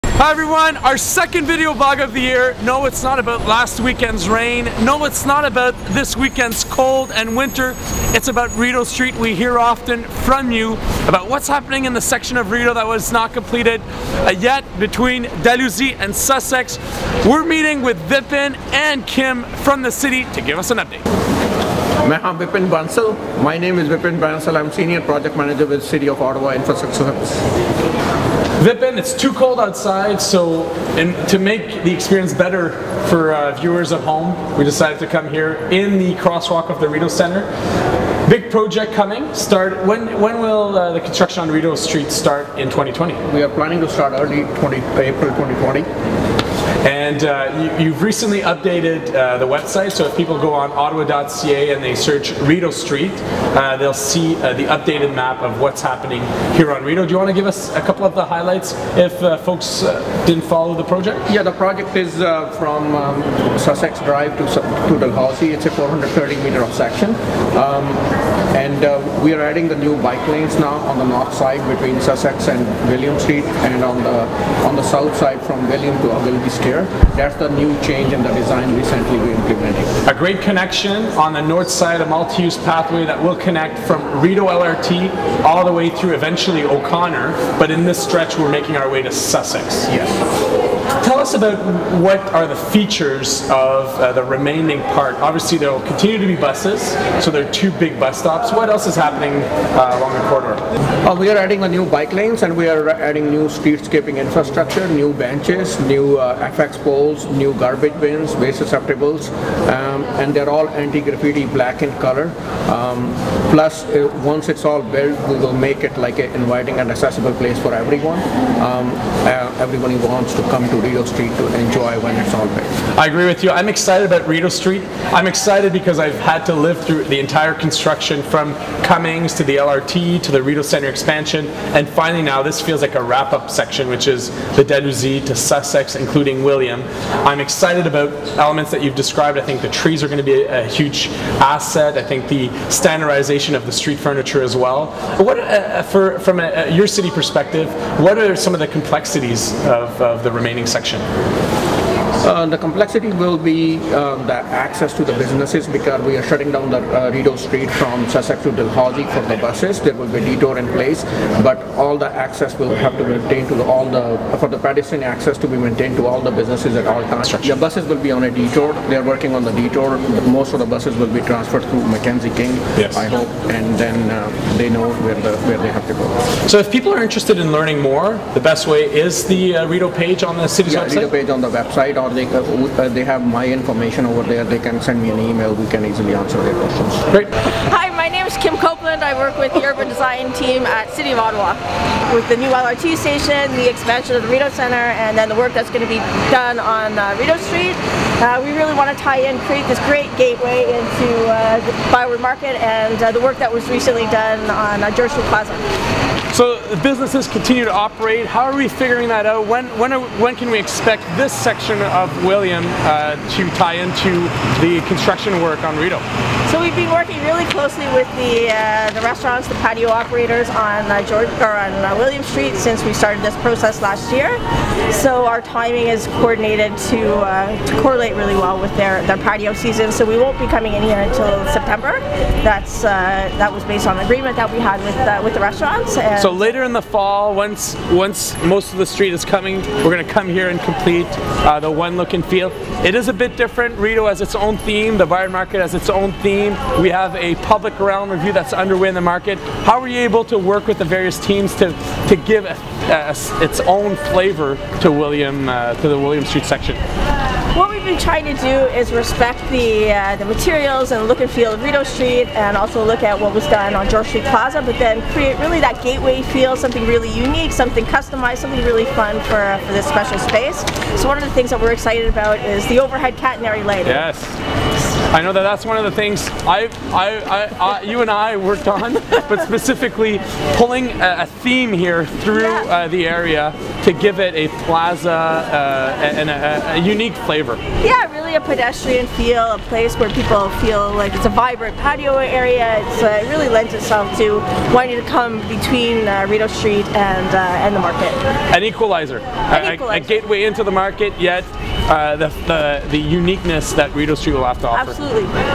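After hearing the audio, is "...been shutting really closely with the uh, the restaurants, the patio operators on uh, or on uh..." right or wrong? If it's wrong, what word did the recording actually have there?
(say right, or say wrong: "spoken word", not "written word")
wrong: "working", not "shutting".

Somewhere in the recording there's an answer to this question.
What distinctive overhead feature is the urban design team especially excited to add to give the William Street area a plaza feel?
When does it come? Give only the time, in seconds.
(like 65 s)
273 s.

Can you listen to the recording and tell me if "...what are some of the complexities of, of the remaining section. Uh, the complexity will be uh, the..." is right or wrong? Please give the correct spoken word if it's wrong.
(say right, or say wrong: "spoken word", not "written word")
right.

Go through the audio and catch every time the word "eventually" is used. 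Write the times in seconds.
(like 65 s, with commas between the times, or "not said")
86 s.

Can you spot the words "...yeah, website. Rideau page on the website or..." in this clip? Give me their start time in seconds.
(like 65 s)
180 s.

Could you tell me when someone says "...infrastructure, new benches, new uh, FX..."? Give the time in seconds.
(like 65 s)
104 s.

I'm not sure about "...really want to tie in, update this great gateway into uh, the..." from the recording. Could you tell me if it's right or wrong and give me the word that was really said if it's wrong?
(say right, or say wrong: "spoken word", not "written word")
wrong: "create", not "update".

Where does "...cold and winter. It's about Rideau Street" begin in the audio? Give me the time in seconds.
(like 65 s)
6 s.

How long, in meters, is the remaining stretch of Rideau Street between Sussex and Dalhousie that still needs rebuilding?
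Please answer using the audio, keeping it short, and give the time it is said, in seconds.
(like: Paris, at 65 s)
430 meters, at 65 s.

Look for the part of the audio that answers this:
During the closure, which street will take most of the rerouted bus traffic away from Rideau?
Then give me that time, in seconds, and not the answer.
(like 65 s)
171 s.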